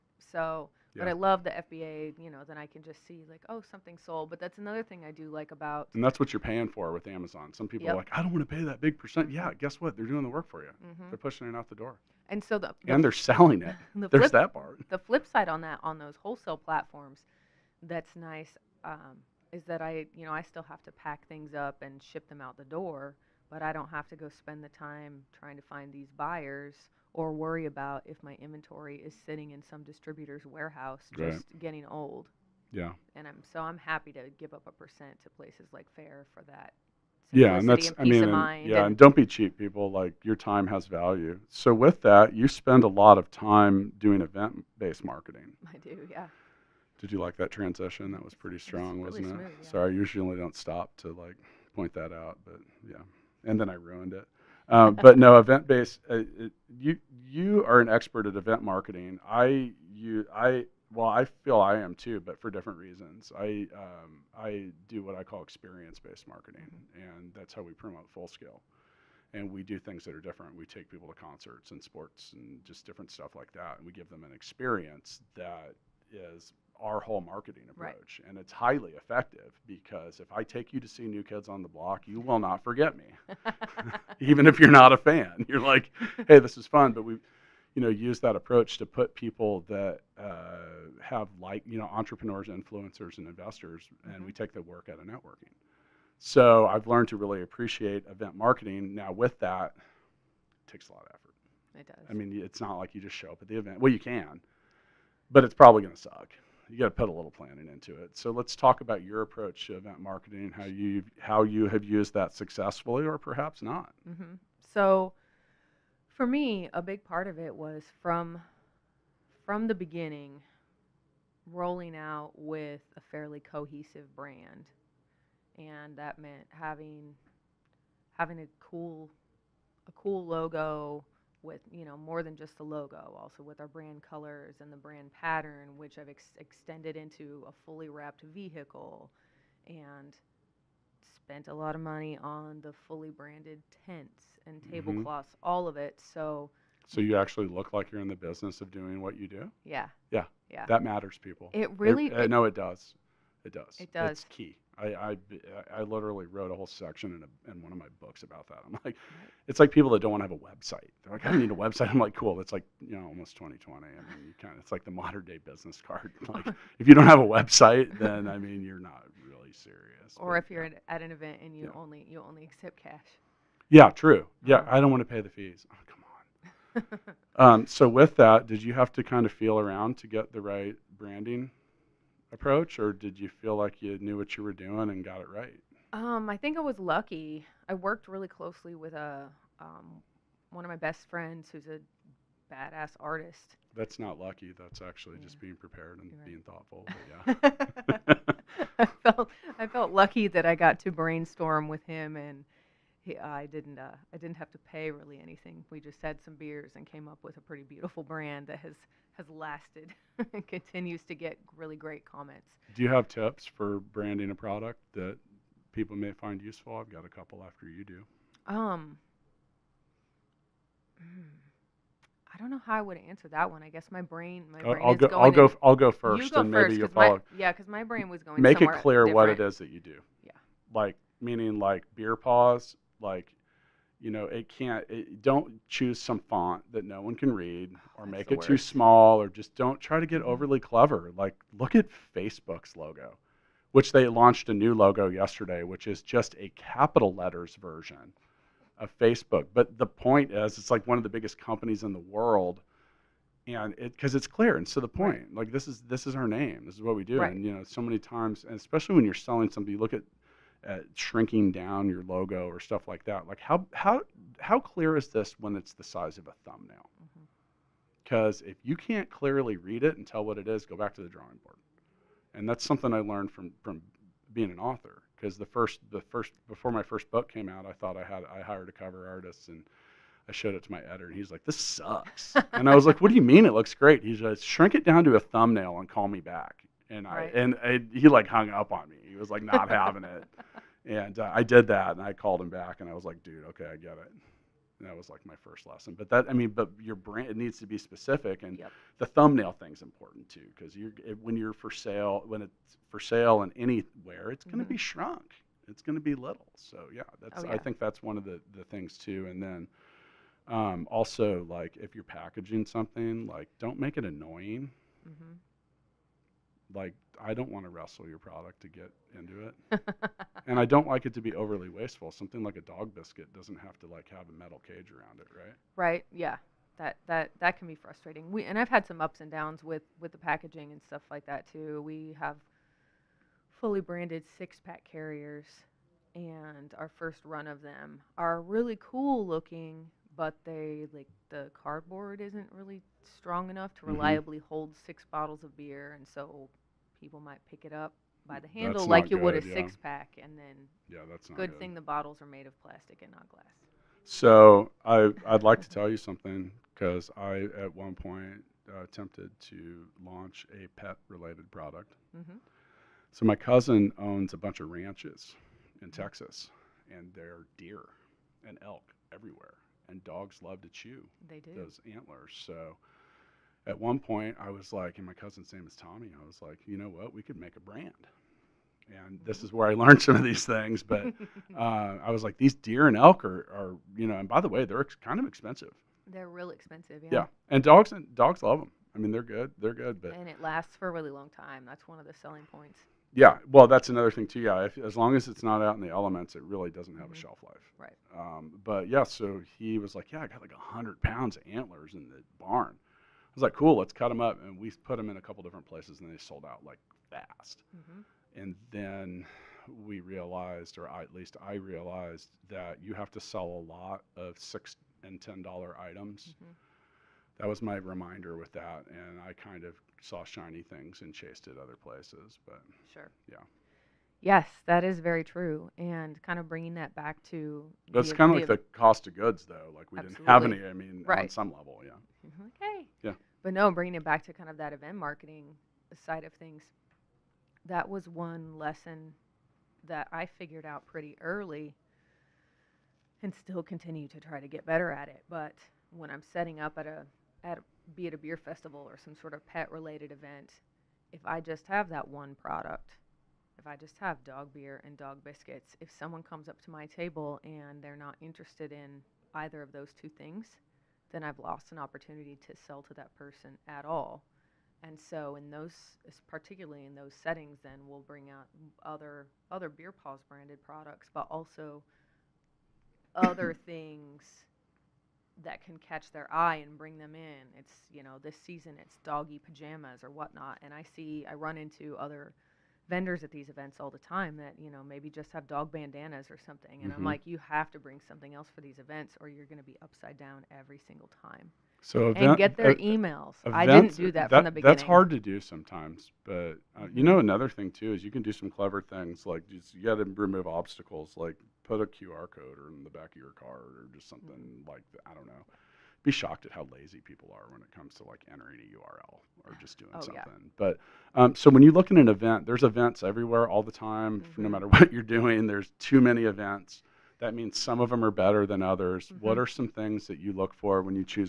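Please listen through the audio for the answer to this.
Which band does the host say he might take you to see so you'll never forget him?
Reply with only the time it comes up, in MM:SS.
01:21.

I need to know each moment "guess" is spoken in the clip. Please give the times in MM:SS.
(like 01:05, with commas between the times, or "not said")
00:09, 02:50, 03:43.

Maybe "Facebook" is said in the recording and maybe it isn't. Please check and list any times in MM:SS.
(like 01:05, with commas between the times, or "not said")
04:02, 04:08.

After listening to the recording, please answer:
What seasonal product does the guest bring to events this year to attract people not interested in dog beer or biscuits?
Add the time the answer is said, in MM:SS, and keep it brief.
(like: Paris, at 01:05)
doggy pajamas, at 07:58.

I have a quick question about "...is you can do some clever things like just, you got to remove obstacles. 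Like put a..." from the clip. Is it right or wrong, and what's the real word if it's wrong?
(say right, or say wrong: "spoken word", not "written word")
right.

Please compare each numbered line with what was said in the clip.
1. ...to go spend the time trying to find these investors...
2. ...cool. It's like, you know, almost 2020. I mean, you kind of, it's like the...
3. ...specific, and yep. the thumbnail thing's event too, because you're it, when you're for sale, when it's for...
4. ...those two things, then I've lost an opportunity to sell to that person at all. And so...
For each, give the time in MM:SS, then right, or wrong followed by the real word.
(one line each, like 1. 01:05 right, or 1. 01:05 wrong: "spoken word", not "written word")
1. 00:24 wrong: "buyers", not "investors"
2. 02:42 right
3. 04:57 wrong: "important", not "event"
4. 07:39 right.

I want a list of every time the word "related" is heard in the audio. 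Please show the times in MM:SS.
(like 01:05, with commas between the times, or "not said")
06:00, 07:29.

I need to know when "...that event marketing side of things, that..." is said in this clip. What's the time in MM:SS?
07:14.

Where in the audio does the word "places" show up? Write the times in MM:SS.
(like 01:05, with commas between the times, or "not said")
00:35, 06:45, 07:01.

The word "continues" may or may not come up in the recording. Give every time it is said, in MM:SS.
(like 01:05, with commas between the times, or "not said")
03:30, 07:23.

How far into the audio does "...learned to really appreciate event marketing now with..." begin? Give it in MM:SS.
01:36.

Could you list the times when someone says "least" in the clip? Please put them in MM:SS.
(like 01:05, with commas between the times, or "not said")
06:51.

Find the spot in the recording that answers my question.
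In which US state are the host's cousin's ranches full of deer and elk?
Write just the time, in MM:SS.
06:05.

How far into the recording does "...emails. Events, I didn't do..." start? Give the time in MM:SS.
08:12.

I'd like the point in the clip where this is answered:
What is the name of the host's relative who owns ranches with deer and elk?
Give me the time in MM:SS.
06:15.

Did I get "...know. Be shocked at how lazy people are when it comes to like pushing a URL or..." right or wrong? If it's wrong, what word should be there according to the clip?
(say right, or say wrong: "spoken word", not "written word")
wrong: "entering", not "pushing".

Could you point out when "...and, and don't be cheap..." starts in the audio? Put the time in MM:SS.
00:38.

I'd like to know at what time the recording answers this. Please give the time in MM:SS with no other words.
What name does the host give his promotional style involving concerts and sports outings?
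01:05.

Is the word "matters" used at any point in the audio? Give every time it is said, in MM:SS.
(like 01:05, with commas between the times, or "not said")
02:30, 08:34.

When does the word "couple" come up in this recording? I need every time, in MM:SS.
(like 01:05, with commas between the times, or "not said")
03:37, 06:45.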